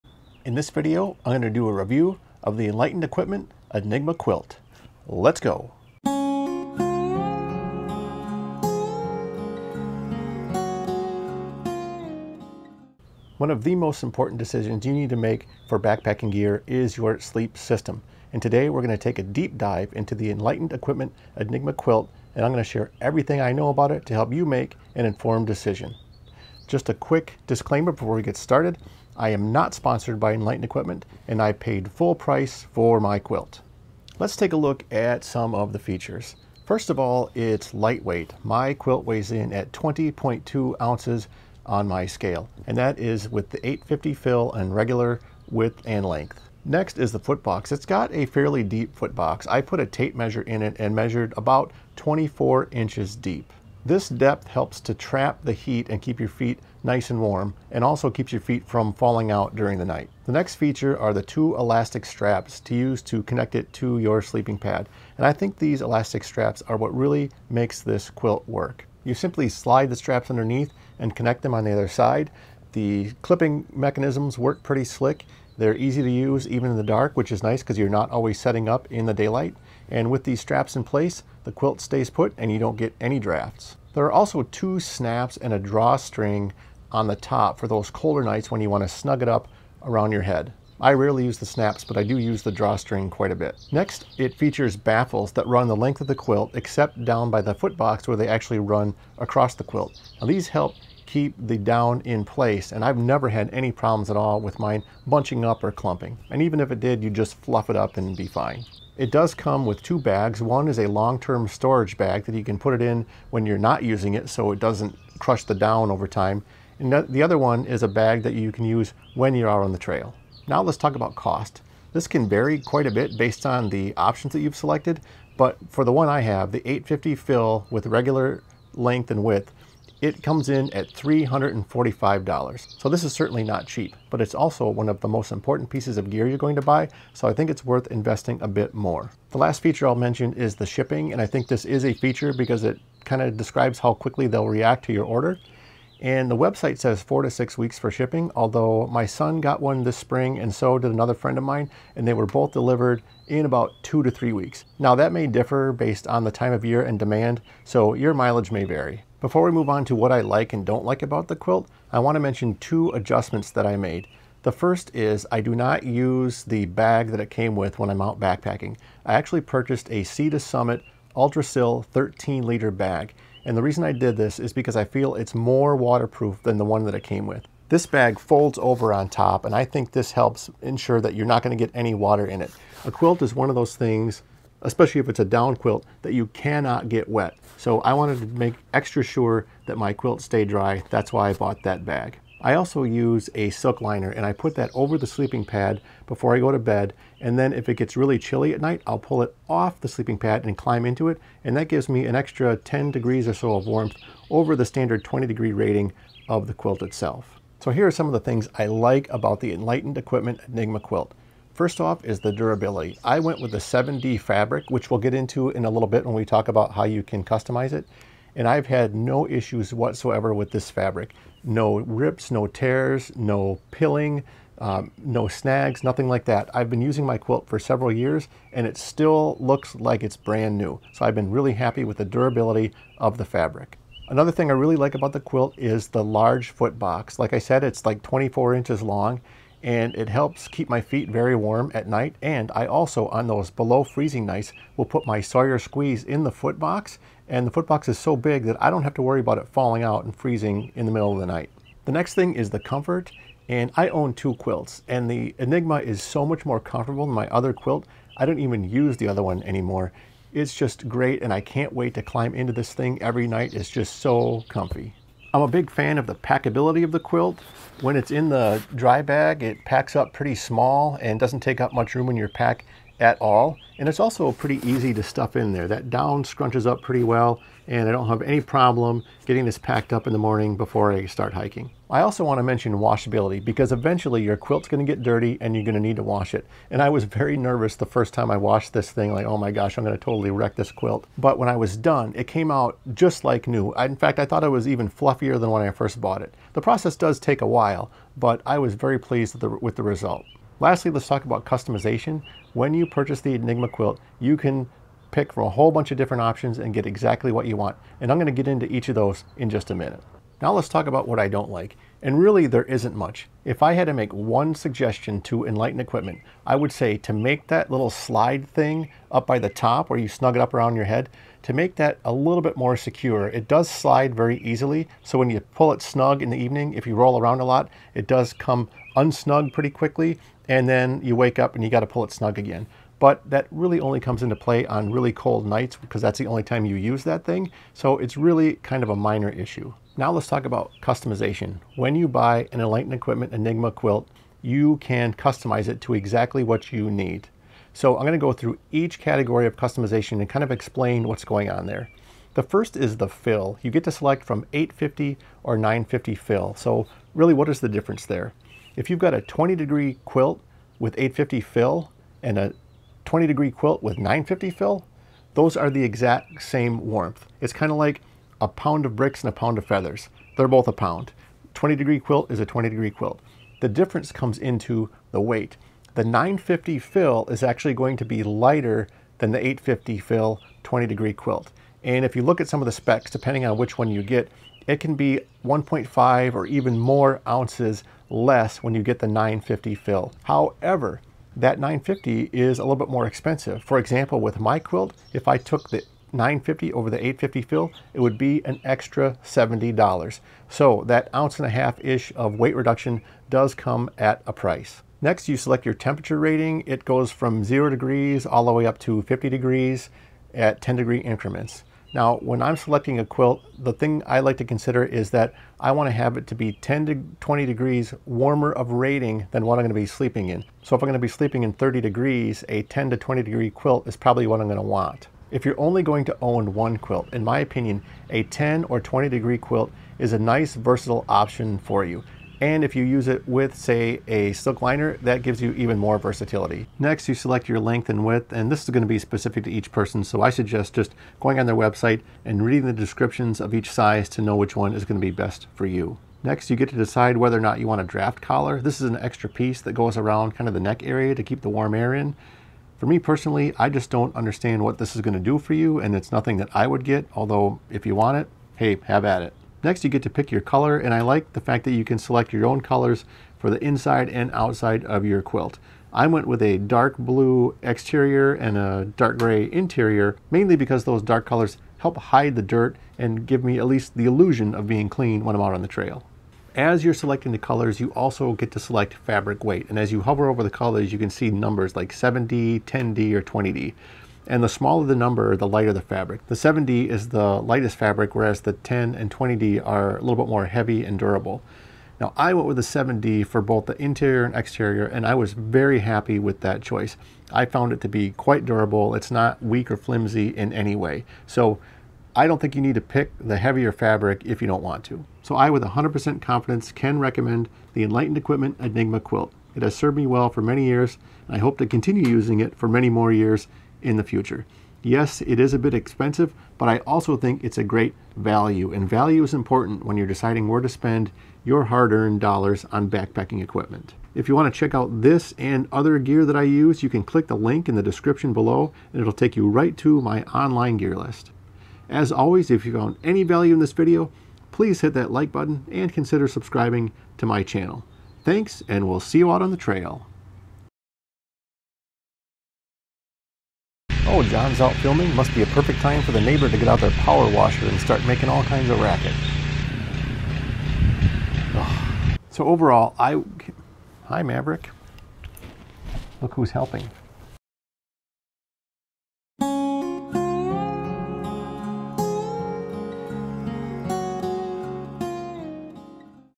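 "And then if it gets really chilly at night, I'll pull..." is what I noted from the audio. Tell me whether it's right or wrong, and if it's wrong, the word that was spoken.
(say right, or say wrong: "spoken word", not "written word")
right.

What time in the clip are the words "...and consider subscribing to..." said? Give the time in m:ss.
8:55.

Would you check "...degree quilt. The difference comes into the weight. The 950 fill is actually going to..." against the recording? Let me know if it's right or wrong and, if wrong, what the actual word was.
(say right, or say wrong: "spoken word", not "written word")
right.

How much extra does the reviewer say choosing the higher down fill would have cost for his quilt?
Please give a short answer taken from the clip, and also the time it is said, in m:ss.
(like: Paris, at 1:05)
$70, at 6:39.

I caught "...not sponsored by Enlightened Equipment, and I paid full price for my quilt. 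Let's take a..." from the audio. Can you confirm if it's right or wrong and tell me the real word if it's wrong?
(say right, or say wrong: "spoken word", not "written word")
right.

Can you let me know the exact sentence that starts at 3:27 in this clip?
So here are some of the things I like about the Enlightened Equipment Enigma quilt.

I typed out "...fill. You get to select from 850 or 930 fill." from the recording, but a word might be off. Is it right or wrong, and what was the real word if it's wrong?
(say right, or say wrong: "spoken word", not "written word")
wrong: "950", not "930".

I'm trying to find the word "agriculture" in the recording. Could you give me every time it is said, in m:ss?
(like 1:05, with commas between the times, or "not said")
not said.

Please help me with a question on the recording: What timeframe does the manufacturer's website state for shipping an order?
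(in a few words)
4 to 6 weeks.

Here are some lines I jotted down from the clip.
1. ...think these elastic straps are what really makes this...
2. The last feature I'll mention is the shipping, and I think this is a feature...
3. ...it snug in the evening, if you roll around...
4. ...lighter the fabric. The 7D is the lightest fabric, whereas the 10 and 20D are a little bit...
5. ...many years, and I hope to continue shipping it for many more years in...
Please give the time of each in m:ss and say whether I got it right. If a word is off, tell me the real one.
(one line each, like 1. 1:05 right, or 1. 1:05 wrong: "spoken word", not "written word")
1. 1:05 right
2. 2:19 right
3. 5:25 right
4. 8:05 right
5. 8:30 wrong: "using", not "shipping".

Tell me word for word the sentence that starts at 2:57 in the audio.
This bag folds over on top and I think this helps ensure that you're not gonna get any water in it.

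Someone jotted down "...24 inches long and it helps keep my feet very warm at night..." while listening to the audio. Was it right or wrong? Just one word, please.
right.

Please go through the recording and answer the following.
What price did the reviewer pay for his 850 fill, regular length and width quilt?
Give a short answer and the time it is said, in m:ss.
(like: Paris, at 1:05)
$345, at 2:10.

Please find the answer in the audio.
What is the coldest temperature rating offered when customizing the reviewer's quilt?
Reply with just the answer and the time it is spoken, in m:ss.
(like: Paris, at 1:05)
0 degrees, at 6:47.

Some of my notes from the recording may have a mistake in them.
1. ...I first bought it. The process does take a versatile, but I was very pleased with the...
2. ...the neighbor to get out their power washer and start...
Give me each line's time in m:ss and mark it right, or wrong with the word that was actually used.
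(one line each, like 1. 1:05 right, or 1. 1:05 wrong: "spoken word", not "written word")
1. 4:55 wrong: "while", not "versatile"
2. 9:06 right.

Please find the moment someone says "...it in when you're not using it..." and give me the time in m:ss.
1:52.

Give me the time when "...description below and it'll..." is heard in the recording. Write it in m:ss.
8:47.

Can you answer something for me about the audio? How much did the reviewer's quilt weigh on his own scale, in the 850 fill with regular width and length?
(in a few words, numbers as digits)
20.2 ounces.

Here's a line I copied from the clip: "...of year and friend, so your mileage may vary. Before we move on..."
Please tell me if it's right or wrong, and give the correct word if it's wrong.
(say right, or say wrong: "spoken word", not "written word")
wrong: "demand", not "friend".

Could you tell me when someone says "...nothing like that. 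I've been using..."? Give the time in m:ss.
3:45.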